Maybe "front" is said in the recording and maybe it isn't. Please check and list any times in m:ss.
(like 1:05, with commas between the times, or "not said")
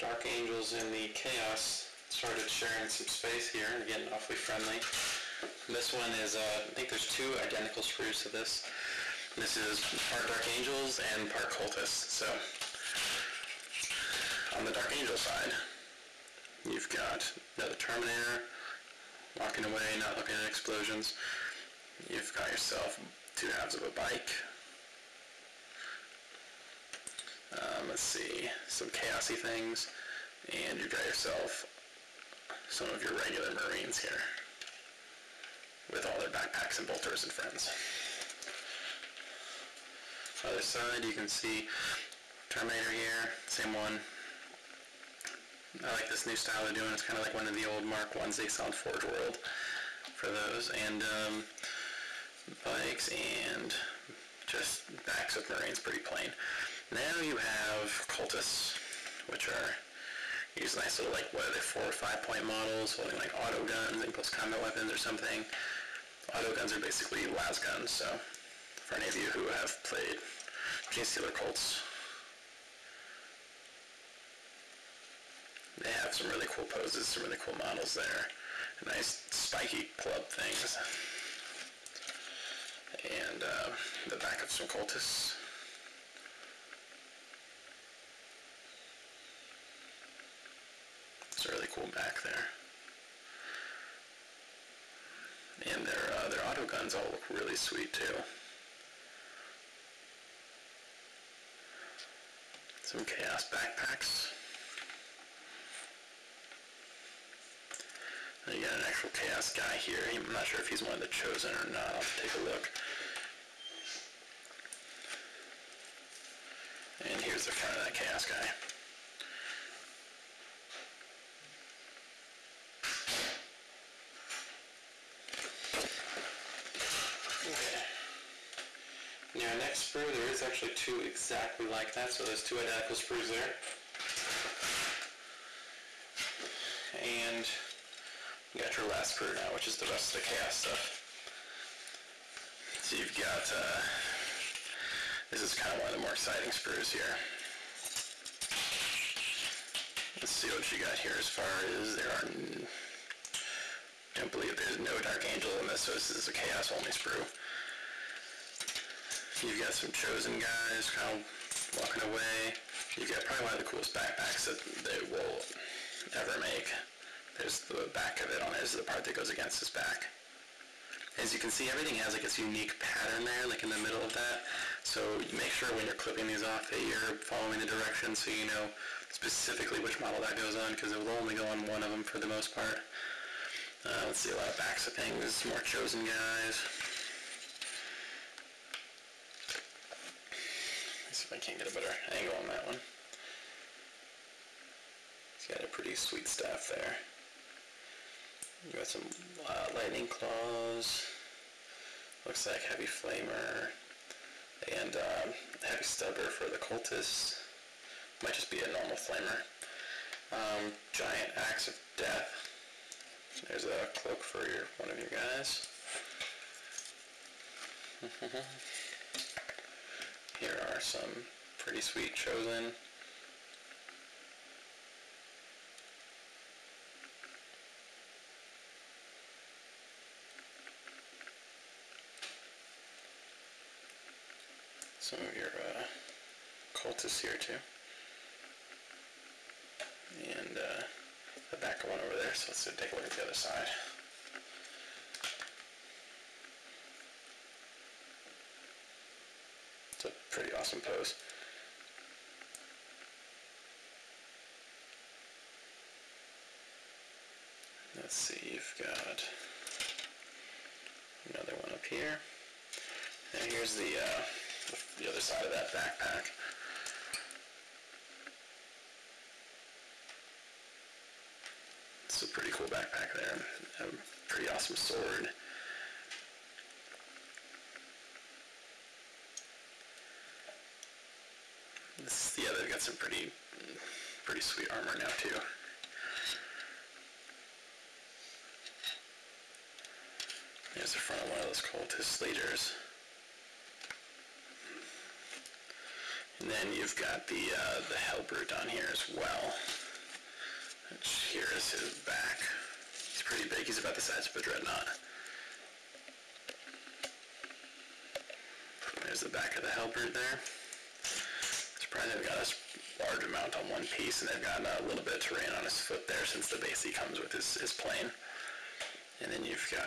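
1:57, 4:50.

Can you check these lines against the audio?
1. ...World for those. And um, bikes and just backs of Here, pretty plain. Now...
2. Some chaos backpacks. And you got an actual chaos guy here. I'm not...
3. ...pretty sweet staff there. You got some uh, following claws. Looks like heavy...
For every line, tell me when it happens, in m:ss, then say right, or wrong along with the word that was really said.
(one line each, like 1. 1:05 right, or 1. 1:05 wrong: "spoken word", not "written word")
1. 0:49 wrong: "Marines", not "Here"
2. 1:42 right
3. 3:15 wrong: "lightning", not "following".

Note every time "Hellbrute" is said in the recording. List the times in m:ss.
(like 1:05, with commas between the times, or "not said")
4:57, 5:09.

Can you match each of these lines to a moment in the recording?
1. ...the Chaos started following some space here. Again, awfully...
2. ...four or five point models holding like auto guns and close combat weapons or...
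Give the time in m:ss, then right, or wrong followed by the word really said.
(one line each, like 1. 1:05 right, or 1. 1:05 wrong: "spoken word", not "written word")
1. 0:00 wrong: "sharing", not "following"
2. 1:01 right.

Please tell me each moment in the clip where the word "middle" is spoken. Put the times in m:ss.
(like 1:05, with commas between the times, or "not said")
2:53.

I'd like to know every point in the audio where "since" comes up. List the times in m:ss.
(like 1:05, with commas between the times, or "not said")
5:16.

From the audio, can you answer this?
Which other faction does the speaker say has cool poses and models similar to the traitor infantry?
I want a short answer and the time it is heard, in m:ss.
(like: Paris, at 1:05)
Genestealer Cults, at 1:10.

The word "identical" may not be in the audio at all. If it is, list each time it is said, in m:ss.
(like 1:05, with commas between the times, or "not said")
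0:07, 2:12.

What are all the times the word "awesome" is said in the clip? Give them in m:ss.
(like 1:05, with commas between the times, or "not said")
4:10, 4:34.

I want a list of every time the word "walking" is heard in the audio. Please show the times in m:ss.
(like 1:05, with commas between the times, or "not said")
0:19, 2:41.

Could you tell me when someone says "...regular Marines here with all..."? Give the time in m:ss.
0:33.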